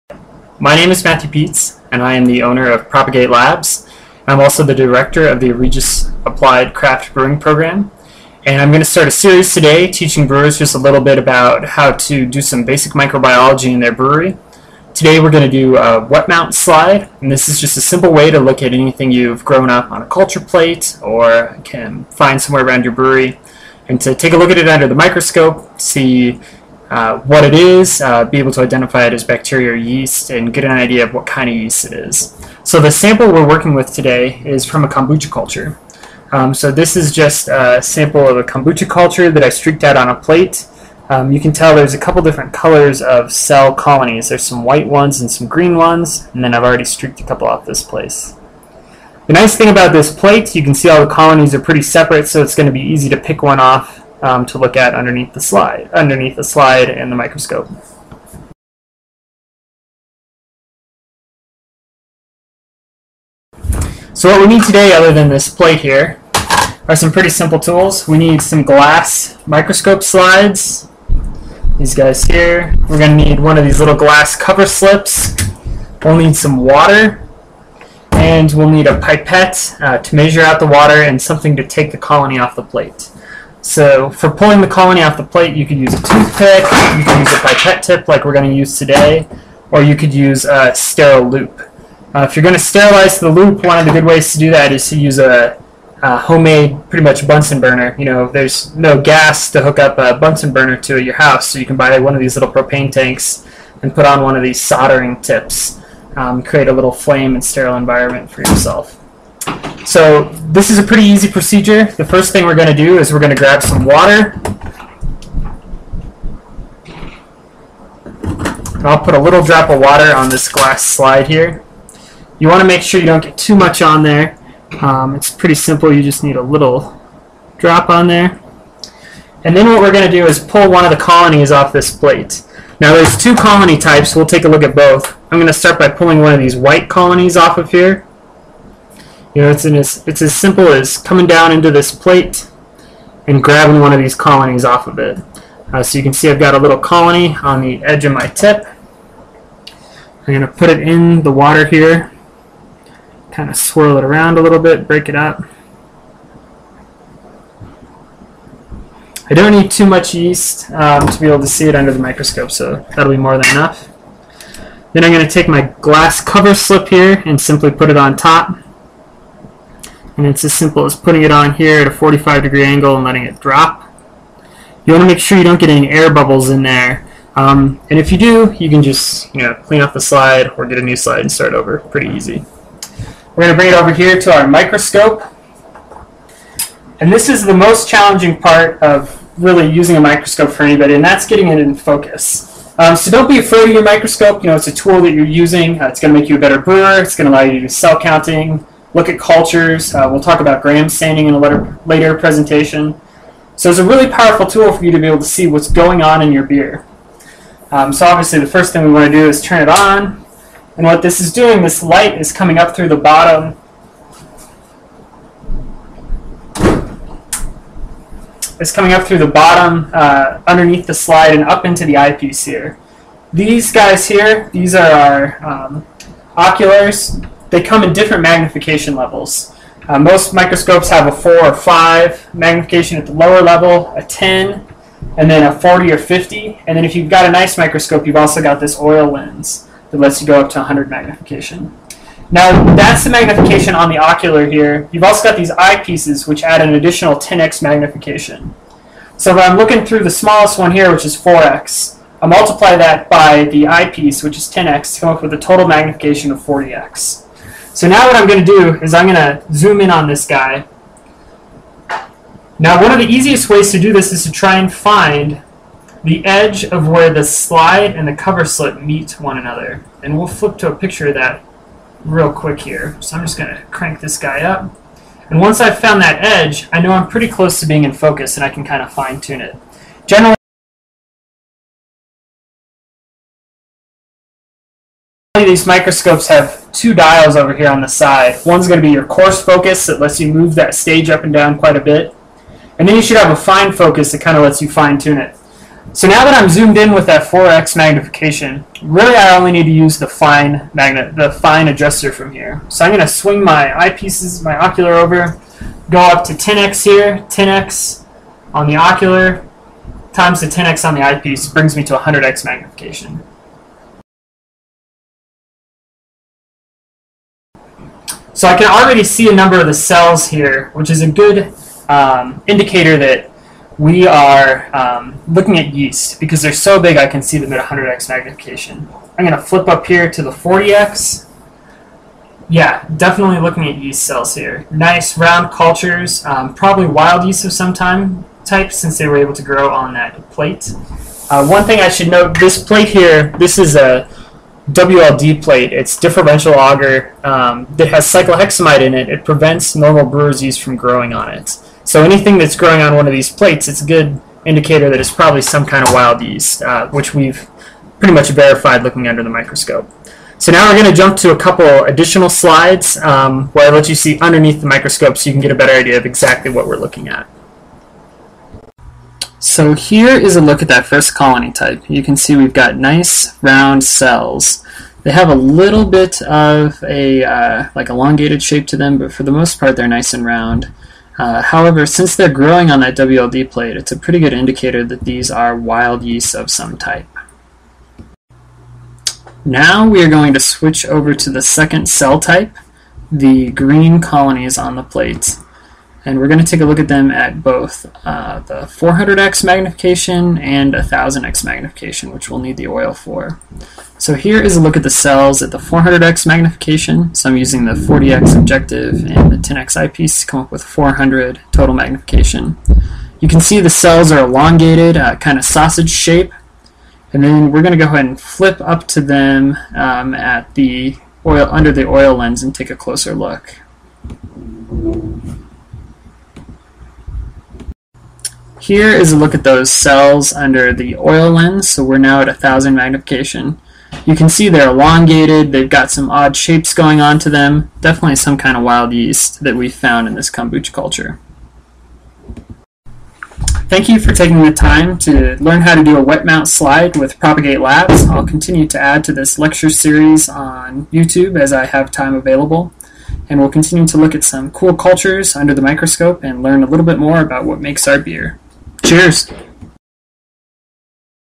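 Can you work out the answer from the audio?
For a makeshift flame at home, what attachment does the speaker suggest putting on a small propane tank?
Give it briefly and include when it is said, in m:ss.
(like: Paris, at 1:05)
soldering tips, at 1:44.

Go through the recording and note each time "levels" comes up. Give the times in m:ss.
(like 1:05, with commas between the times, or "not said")
3:48, 3:53.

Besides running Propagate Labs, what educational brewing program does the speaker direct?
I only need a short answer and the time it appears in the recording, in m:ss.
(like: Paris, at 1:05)
Regis Applied Craft Brewing Program, at 0:05.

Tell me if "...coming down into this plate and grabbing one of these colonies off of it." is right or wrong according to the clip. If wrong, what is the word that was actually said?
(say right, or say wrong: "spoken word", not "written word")
right.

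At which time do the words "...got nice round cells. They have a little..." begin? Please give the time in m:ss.
6:12.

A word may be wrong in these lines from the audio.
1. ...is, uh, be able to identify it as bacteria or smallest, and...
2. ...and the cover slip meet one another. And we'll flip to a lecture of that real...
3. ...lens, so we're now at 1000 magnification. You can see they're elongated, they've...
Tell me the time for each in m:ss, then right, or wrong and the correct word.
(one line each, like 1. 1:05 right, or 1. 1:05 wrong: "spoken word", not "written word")
1. 0:27 wrong: "yeast", not "smallest"
2. 4:27 wrong: "picture", not "lecture"
3. 7:11 right.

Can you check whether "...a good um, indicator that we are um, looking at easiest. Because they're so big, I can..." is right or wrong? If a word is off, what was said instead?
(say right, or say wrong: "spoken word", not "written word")
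wrong: "yeast", not "easiest".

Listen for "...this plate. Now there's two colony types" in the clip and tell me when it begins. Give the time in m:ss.
2:11.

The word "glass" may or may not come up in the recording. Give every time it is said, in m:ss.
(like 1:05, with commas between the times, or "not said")
1:08, 1:13, 2:00, 2:45.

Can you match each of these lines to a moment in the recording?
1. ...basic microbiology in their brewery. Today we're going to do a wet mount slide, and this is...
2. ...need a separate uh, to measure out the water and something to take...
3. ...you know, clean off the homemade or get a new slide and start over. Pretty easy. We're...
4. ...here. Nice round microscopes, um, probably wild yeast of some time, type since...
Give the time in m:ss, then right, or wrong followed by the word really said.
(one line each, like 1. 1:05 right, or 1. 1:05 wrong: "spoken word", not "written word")
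1. 0:12 right
2. 1:18 wrong: "pipette", not "separate"
3. 2:59 wrong: "slide", not "homemade"
4. 5:34 wrong: "cultures", not "microscopes".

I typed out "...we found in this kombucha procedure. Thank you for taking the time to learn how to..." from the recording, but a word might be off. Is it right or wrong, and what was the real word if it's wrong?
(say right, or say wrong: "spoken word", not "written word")
wrong: "culture", not "procedure".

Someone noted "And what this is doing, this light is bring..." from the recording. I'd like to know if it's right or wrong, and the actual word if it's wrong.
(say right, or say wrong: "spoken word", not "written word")
wrong: "coming", not "bring".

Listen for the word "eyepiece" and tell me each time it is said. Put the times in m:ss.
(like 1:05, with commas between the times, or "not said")
3:41, 4:05, 4:13, 5:03, 5:11, 6:49.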